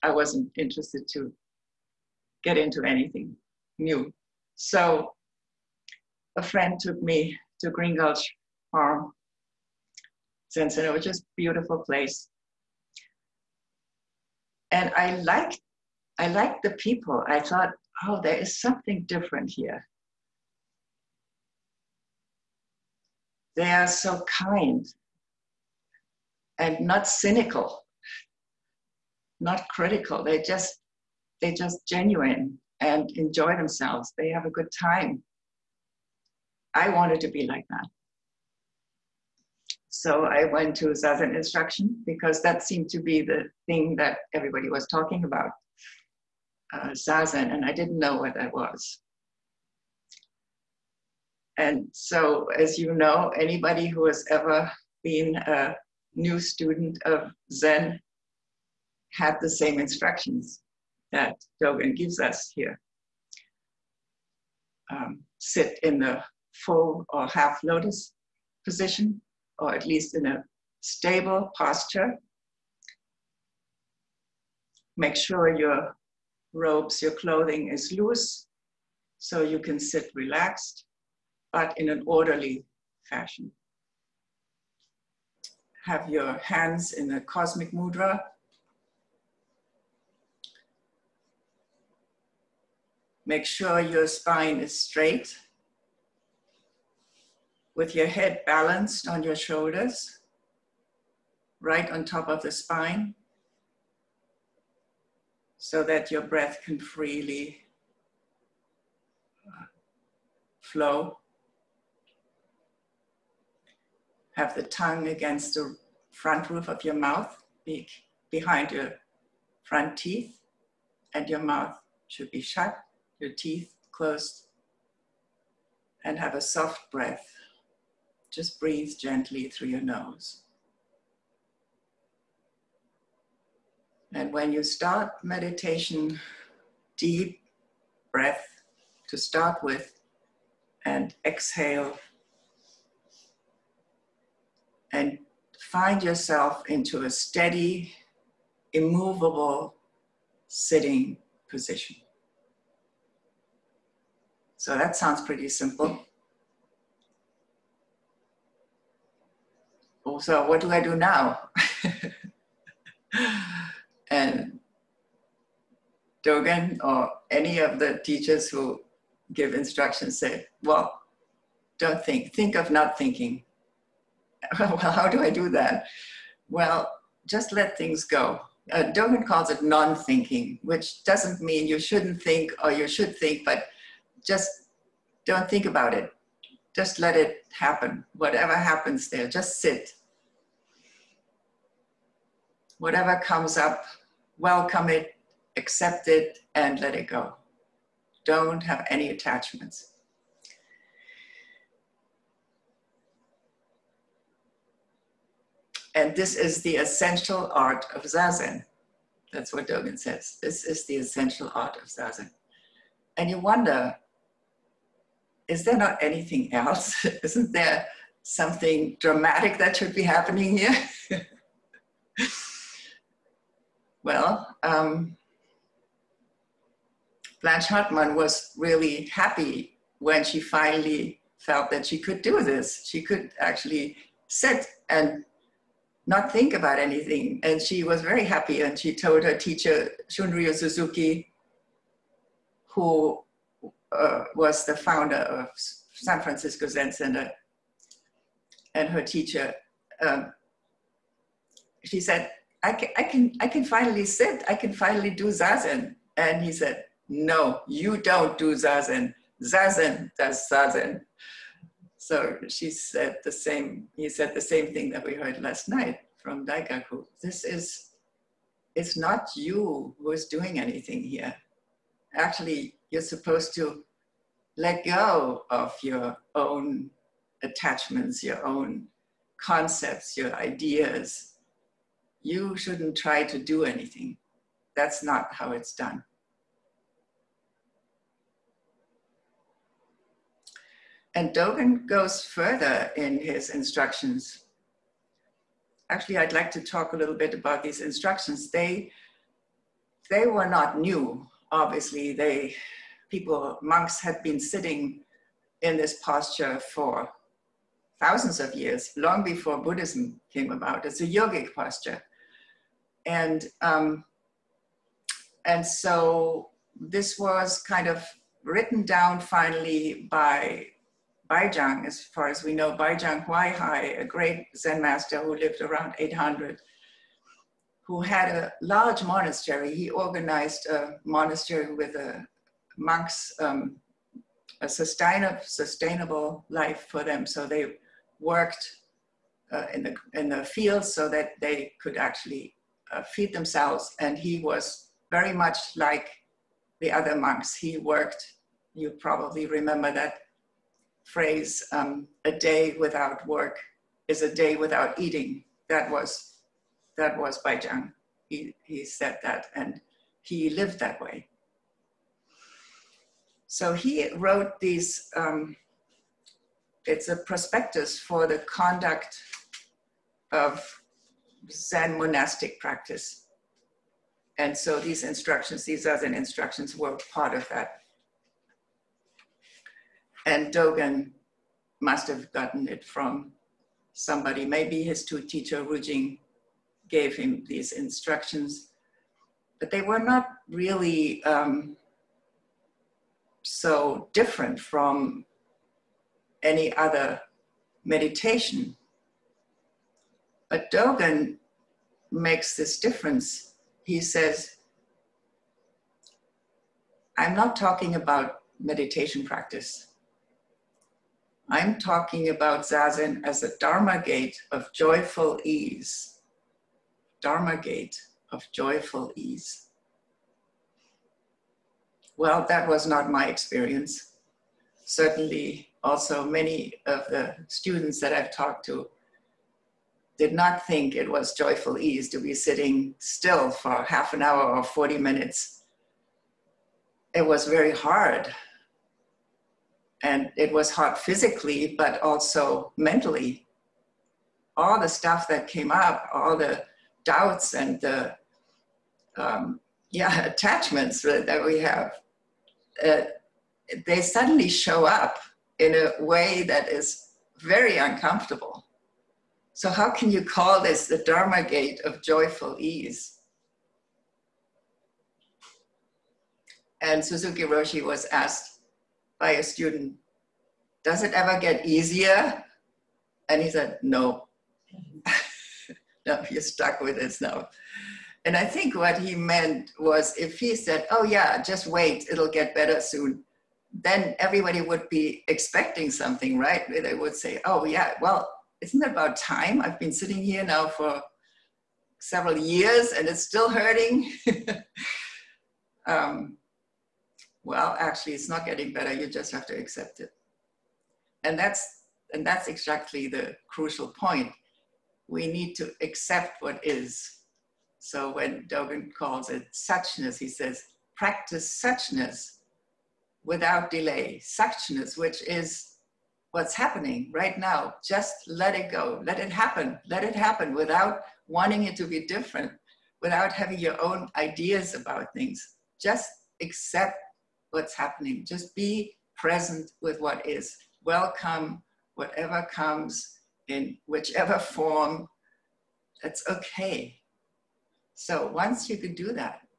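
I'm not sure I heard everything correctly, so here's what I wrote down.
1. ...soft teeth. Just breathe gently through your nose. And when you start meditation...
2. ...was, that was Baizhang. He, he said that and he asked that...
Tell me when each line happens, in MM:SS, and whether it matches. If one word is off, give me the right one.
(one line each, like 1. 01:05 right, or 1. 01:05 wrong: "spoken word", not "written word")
1. 02:06 wrong: "breath", not "teeth"
2. 05:55 wrong: "lived", not "asked".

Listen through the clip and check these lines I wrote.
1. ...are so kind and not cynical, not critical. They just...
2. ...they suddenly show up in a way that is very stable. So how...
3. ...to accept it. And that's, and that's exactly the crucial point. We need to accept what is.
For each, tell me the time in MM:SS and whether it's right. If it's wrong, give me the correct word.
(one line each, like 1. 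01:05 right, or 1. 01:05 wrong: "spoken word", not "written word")
1. 00:23 right
2. 07:33 wrong: "uncomfortable", not "stable"
3. 08:19 right.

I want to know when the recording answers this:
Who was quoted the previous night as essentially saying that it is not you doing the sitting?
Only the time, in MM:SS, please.
04:26.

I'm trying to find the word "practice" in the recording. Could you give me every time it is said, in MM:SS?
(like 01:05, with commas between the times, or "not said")
06:12, 06:49, 08:30.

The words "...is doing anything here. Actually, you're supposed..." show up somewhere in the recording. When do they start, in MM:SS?
04:30.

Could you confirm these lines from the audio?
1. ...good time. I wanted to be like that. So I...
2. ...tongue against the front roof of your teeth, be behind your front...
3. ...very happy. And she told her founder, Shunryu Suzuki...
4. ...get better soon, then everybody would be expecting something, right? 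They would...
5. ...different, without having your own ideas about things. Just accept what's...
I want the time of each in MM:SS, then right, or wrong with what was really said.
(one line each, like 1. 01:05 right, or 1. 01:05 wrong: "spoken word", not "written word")
1. 00:34 right
2. 01:54 wrong: "mouth", not "teeth"
3. 03:58 wrong: "teacher", not "founder"
4. 08:02 right
5. 08:42 right.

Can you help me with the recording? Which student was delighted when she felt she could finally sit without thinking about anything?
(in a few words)
Blanche Hartman.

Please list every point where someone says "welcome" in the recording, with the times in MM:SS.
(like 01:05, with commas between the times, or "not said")
03:14, 08:50.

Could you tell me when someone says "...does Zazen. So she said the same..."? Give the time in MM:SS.
04:20.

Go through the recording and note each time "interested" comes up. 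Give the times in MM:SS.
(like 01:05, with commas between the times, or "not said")
00:00.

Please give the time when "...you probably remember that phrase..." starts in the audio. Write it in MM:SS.
05:48.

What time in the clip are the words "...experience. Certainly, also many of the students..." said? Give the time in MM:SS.
07:03.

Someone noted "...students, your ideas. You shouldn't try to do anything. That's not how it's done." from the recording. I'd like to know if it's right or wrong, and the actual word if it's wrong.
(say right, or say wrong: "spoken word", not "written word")
wrong: "concepts", not "students".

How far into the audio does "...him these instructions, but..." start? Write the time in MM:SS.
06:27.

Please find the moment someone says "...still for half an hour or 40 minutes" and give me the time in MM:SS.
07:12.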